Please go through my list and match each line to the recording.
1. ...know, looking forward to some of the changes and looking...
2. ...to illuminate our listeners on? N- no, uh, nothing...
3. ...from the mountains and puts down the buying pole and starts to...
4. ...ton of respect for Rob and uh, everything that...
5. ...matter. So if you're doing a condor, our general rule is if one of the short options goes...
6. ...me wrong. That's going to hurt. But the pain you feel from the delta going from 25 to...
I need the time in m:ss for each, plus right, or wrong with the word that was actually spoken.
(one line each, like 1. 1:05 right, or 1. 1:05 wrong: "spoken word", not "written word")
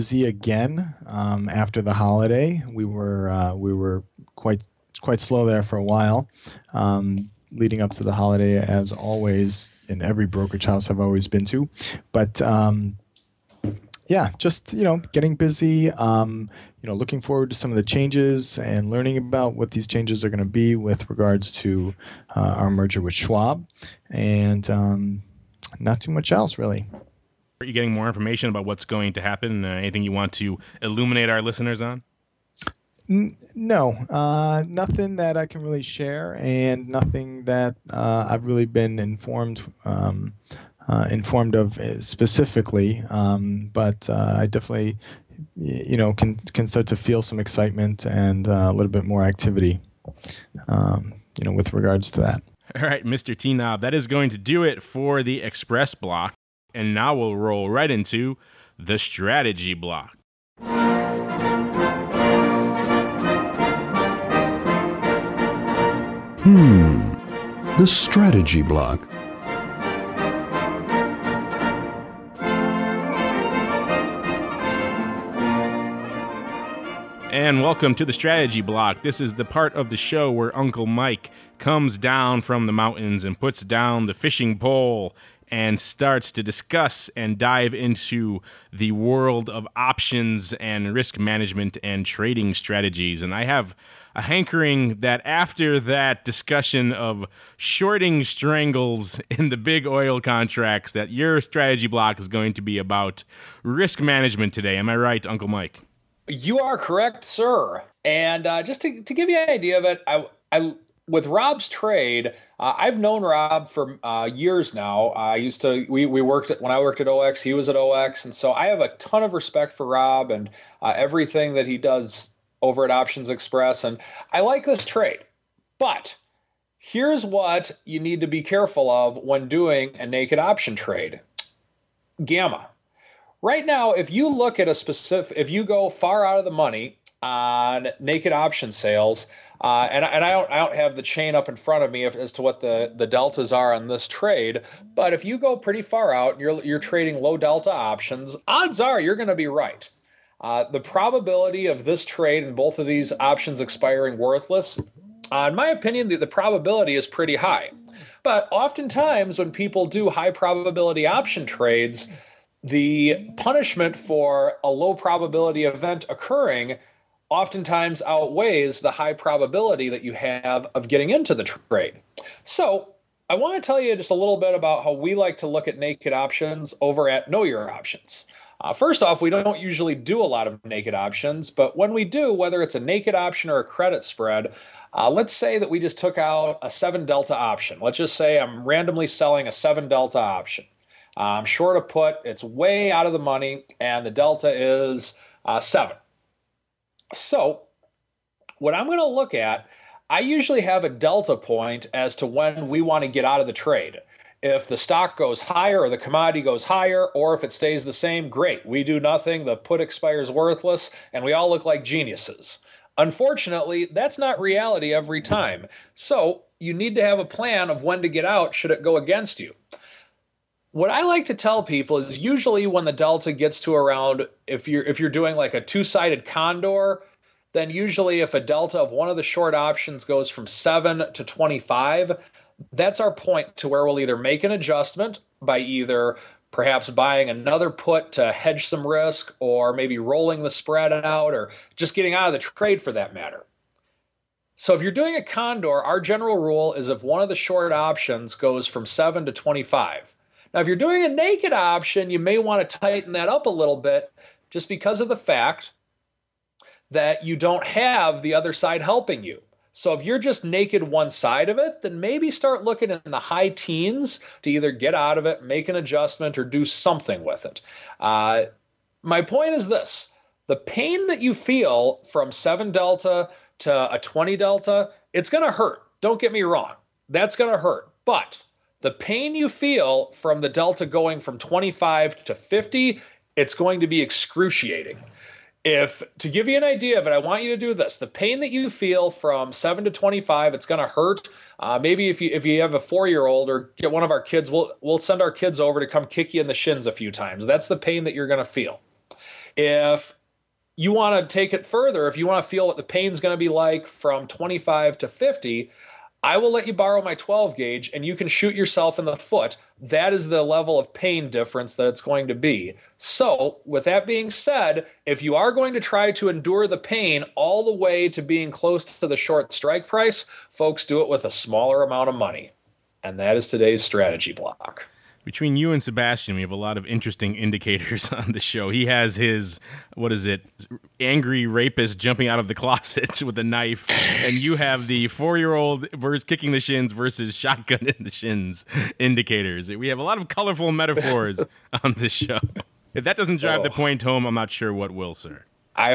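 1. 0:16 wrong: "learning", not "looking"
2. 0:30 right
3. 1:22 wrong: "fishing", not "buying"
4. 1:58 right
5. 4:03 right
6. 4:36 right.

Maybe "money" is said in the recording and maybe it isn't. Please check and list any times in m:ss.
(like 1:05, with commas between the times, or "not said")
2:16, 3:13, 5:22.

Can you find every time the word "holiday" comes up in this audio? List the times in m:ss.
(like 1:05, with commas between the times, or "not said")
0:01, 0:08.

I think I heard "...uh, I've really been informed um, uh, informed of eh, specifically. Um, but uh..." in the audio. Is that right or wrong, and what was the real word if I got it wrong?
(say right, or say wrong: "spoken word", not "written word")
right.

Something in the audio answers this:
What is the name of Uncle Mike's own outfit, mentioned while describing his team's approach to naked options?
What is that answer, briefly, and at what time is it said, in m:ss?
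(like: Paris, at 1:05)
Know Your Options, at 2:57.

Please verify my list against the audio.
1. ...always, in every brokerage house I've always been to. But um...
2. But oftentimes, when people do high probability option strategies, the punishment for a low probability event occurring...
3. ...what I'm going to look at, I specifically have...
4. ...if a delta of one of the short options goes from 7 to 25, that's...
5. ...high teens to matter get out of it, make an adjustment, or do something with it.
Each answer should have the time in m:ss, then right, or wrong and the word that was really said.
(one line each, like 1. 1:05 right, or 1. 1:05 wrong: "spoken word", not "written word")
1. 0:08 right
2. 2:38 wrong: "trades", not "strategies"
3. 3:18 wrong: "usually", not "specifically"
4. 3:48 right
5. 4:23 wrong: "either", not "matter".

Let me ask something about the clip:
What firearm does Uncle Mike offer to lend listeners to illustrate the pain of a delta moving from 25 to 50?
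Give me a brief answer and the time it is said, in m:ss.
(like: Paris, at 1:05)
12 gauge, at 5:07.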